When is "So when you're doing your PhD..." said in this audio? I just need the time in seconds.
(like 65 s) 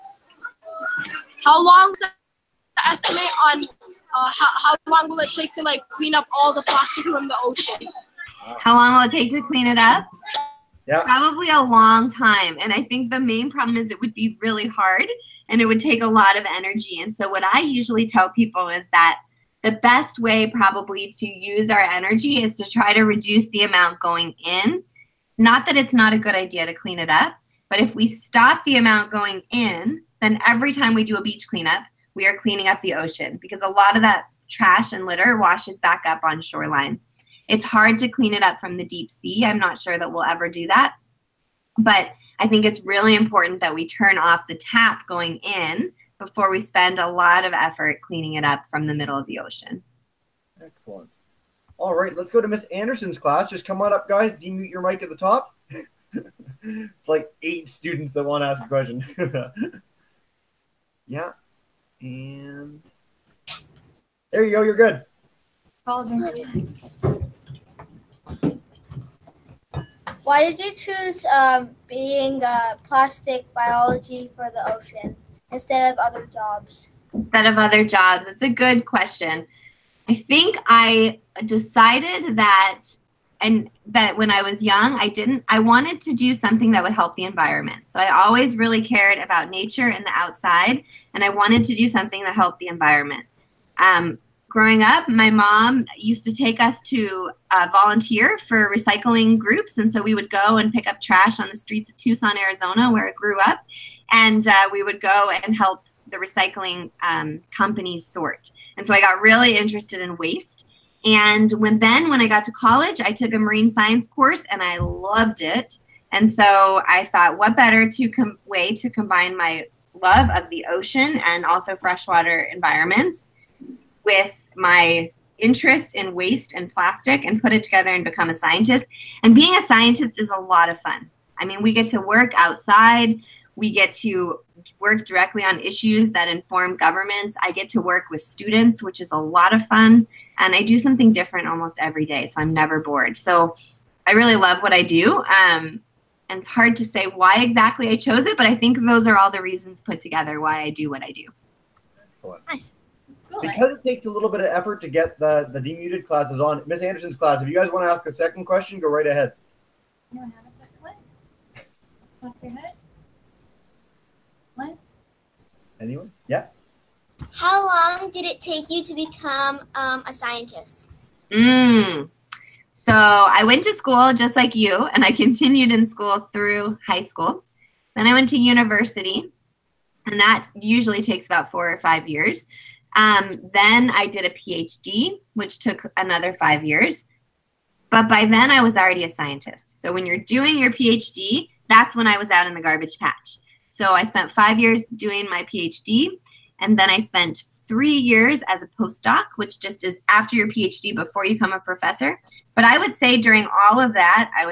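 189 s.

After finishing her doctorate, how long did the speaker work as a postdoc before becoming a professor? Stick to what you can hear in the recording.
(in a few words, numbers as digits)
3 years.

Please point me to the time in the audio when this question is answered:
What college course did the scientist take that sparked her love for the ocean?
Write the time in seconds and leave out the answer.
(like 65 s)
113 s.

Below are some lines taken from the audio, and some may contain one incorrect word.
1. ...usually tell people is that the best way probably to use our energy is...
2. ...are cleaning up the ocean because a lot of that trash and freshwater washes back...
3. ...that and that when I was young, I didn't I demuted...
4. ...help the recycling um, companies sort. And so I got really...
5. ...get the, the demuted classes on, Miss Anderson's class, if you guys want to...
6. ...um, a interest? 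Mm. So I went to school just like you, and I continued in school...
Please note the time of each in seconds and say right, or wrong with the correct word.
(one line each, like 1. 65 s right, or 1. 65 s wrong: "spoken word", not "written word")
1. 17 s right
2. 32 s wrong: "litter", not "freshwater"
3. 82 s wrong: "wanted", not "demuted"
4. 105 s right
5. 154 s right
6. 169 s wrong: "scientist", not "interest".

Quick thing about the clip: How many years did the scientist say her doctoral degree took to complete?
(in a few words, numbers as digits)
5 years.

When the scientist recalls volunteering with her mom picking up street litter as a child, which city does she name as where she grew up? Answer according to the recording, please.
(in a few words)
Tucson, Arizona.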